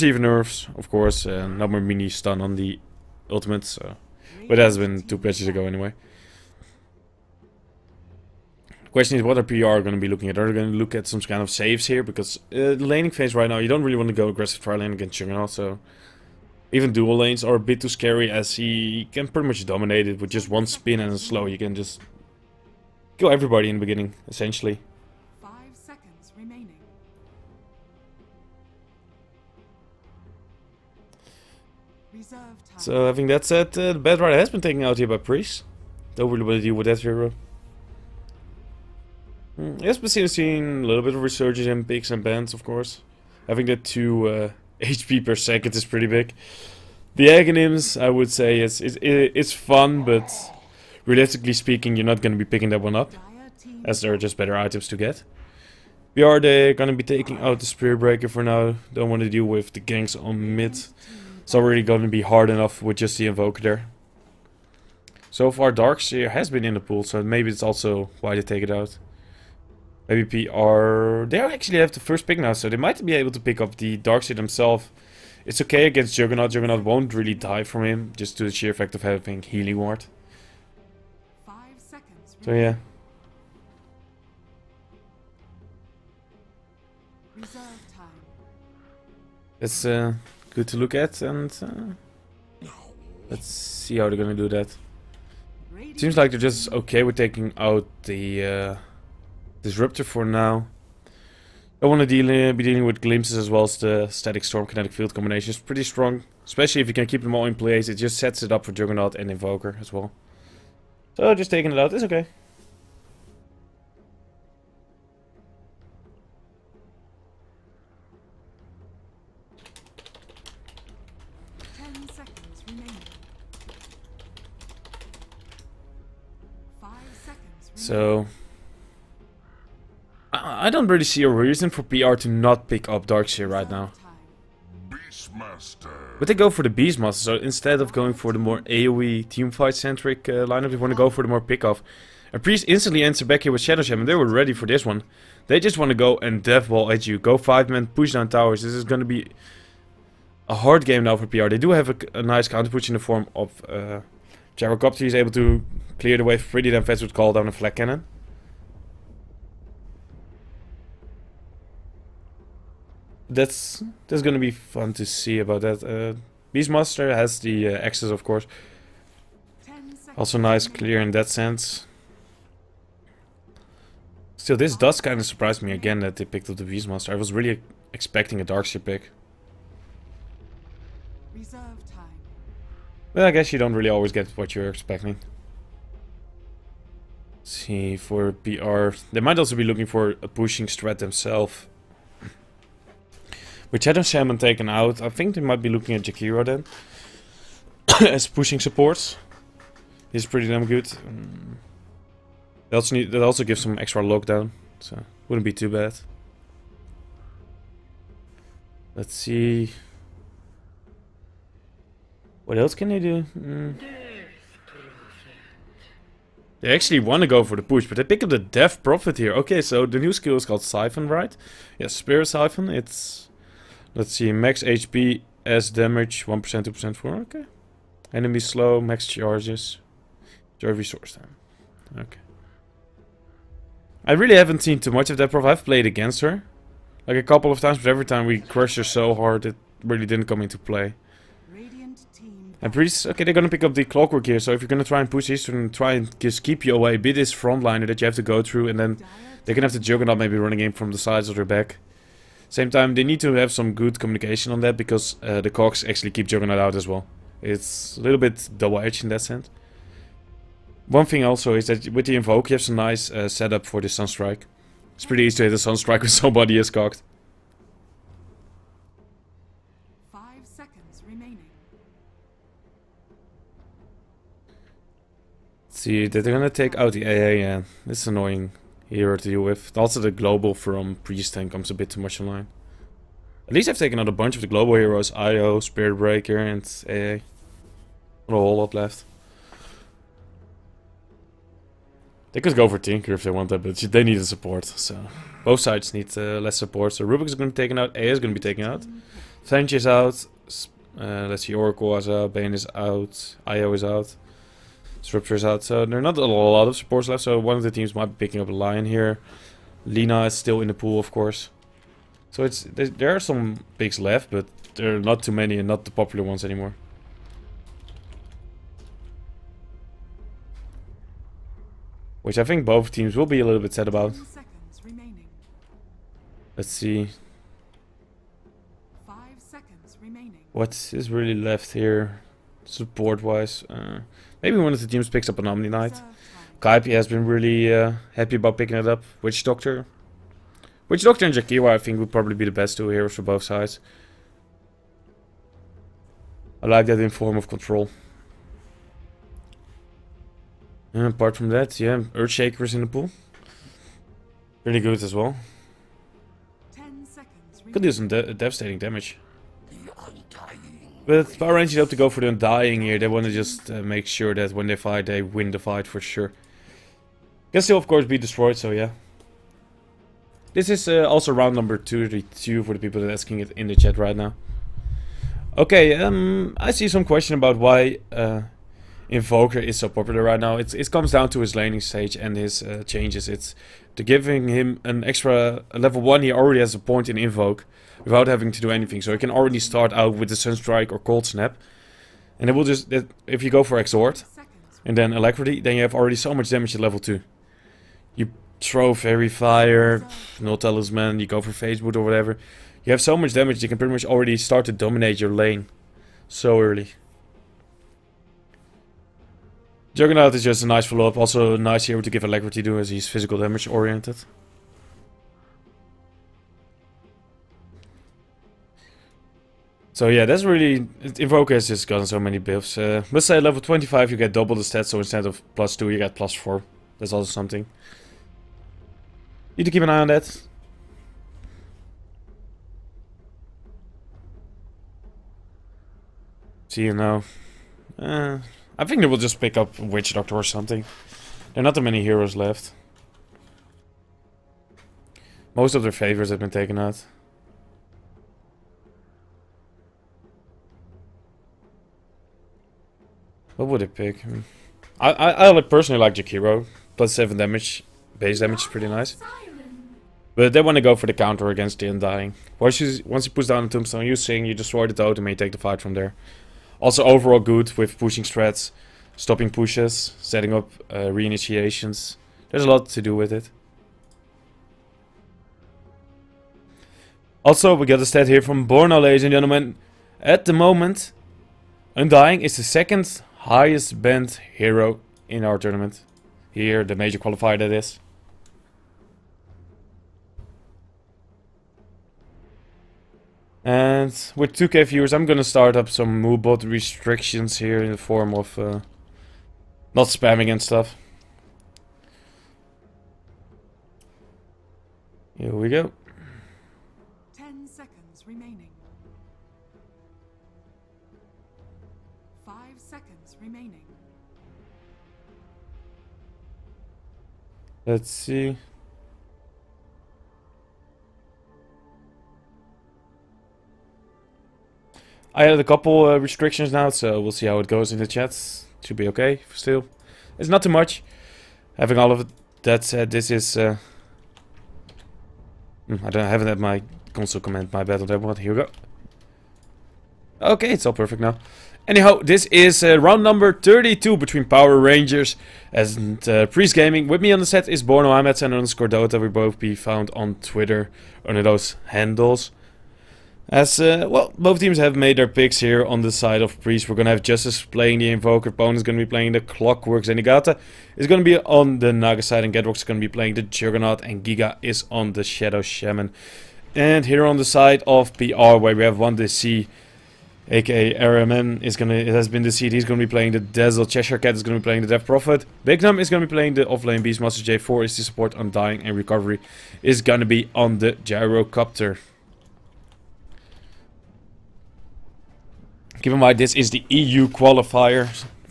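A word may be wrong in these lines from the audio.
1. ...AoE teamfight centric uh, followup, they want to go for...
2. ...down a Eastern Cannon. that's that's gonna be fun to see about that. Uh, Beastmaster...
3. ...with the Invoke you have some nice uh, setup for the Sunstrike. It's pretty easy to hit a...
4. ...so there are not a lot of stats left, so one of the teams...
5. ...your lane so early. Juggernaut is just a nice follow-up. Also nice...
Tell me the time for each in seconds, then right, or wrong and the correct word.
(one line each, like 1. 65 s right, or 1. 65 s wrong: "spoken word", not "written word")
1. 138 s wrong: "lineup", not "followup"
2. 157 s wrong: "Flak", not "Eastern"
3. 261 s right
4. 305 s wrong: "supports", not "stats"
5. 405 s right.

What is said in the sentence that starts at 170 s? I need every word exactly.
Also nice, clear in that sense.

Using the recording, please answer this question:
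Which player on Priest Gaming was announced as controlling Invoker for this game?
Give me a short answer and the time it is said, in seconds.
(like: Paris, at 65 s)
Justice, at 557 s.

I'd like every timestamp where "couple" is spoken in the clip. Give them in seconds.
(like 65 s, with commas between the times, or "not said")
237 s, 525 s.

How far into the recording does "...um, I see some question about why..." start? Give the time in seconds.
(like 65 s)
375 s.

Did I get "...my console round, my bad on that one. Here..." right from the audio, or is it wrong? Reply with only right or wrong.
wrong.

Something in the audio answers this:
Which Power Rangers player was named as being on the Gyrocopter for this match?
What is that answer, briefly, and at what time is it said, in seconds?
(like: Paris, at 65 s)
Recovery, at 578 s.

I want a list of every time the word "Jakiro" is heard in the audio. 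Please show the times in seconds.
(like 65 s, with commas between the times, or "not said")
196 s, 341 s, 456 s.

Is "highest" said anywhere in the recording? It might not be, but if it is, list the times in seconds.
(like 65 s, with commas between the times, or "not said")
483 s.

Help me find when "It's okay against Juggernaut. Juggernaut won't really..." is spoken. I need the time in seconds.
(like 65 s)
75 s.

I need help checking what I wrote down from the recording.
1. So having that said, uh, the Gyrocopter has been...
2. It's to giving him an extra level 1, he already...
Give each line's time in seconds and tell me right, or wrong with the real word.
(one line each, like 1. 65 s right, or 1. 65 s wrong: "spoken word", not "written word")
1. 32 s wrong: "Batrider", not "Gyrocopter"
2. 383 s right.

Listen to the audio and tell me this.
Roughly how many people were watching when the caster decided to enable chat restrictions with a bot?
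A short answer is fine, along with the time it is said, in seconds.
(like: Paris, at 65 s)
2,000, at 494 s.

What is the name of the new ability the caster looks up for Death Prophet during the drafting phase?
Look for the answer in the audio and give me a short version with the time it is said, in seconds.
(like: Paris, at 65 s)
Spirit Siphon, at 221 s.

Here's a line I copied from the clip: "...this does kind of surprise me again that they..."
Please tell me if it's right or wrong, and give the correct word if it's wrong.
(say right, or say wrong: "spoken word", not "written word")
right.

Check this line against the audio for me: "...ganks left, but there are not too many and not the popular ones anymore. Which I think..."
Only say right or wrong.
wrong.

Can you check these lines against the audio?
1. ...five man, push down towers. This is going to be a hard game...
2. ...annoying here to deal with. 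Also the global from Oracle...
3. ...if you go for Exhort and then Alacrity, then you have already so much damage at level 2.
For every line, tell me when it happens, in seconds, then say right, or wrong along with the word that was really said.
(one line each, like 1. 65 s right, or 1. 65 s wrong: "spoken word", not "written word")
1. 147 s right
2. 278 s wrong: "Priest", not "Oracle"
3. 393 s right.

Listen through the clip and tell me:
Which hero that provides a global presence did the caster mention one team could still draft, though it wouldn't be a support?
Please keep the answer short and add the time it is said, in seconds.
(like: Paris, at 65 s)
Tinker, at 292 s.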